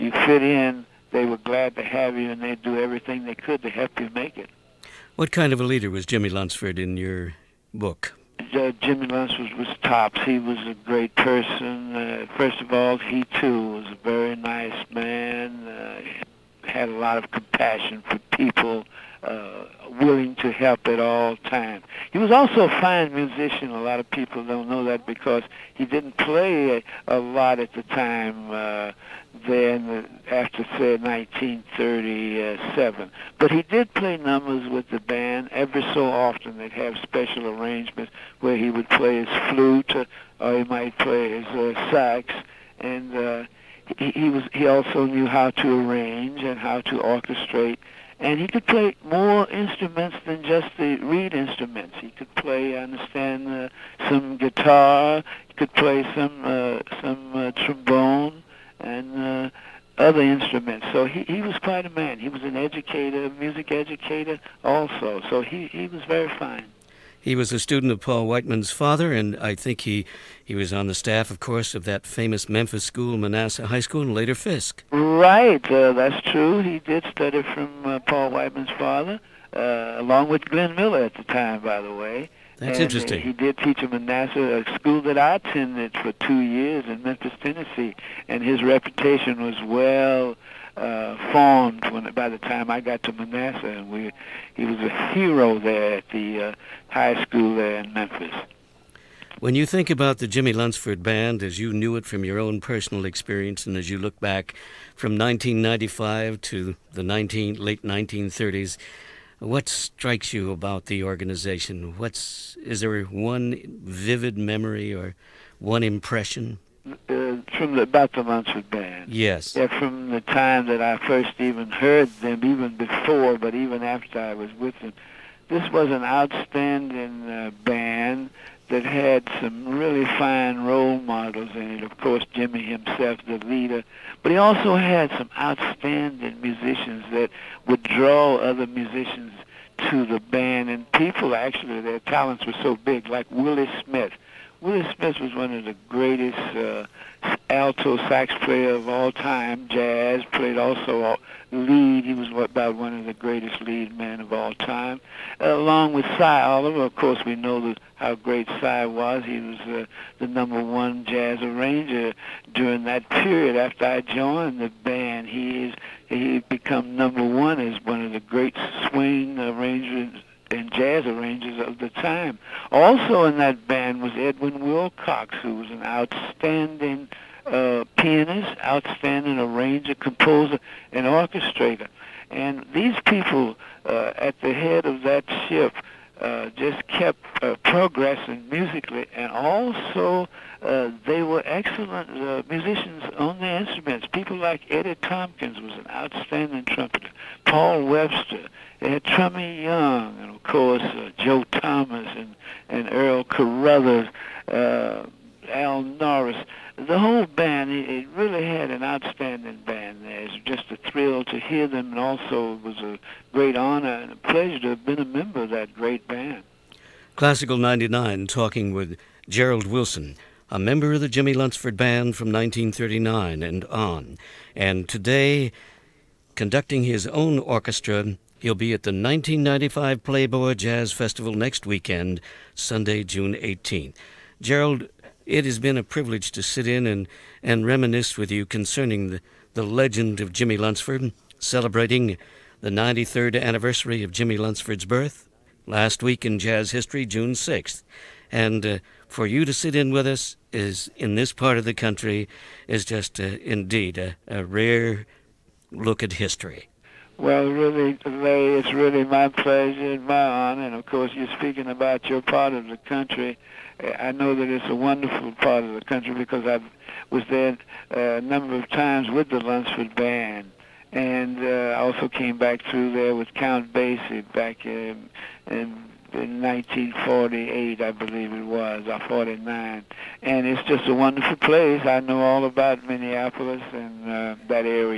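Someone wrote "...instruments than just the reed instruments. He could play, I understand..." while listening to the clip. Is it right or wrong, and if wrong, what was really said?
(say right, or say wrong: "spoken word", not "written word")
right.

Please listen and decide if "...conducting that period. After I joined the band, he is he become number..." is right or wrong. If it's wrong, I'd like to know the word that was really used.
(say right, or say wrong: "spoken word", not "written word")
wrong: "during", not "conducting".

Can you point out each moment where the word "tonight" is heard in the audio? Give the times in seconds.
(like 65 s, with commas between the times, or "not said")
not said.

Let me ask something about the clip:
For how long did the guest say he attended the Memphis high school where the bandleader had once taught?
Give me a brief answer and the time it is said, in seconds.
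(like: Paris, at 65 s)
2 years, at 86 s.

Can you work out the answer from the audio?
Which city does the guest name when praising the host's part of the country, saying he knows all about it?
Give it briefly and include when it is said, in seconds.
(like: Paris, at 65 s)
Minneapolis, at 282 s.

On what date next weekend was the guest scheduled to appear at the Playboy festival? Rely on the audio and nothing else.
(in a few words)
June 18th.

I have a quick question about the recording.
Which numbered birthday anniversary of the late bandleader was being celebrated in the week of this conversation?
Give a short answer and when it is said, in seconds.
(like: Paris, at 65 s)
93rd, at 242 s.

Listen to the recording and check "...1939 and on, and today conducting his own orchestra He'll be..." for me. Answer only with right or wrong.
right.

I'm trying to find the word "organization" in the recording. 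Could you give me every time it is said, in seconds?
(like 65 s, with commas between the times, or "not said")
111 s.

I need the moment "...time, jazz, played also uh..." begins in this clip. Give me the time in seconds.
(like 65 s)
149 s.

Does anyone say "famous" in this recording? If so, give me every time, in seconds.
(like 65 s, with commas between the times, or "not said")
72 s.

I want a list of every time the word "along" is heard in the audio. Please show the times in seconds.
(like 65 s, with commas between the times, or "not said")
79 s, 155 s.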